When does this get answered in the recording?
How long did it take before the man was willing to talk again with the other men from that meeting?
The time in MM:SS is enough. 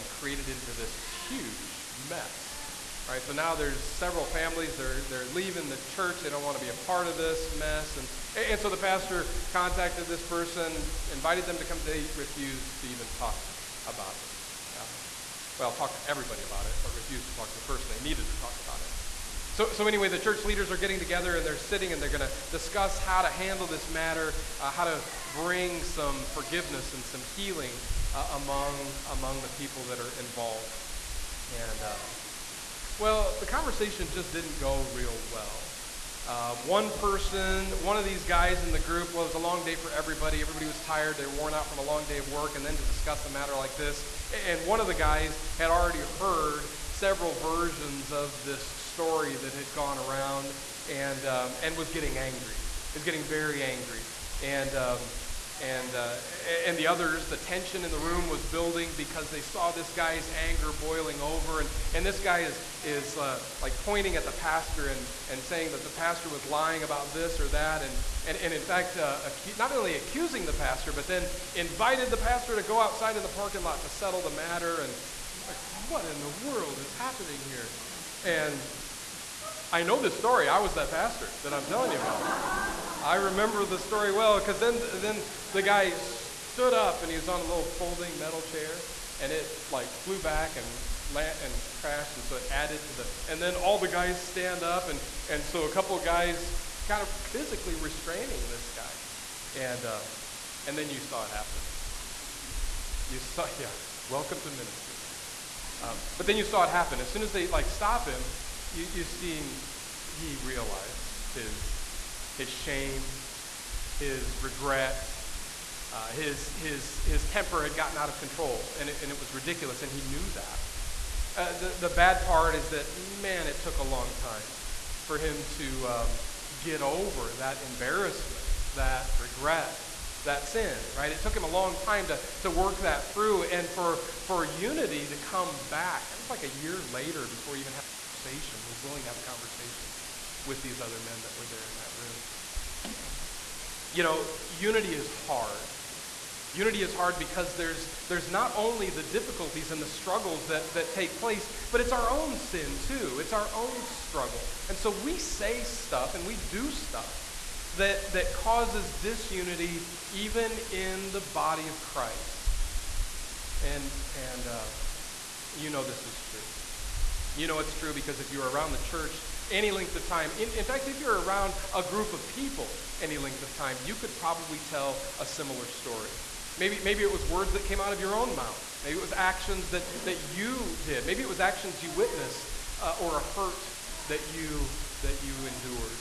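02:16.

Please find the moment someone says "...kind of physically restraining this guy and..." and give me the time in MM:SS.
01:36.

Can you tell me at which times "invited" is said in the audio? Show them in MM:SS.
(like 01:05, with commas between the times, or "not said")
00:11, 01:11.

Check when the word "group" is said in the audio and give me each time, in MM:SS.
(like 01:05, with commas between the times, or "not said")
00:38, 02:51.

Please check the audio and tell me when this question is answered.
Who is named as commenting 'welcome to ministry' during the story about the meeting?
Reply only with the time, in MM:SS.
01:45.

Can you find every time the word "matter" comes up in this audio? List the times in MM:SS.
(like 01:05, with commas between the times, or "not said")
00:23, 00:43, 01:14.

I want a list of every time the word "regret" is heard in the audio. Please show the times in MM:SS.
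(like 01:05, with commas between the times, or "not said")
01:54, 02:09.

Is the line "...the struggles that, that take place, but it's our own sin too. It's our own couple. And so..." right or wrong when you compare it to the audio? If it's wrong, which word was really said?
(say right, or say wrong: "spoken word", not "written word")
wrong: "struggle", not "couple".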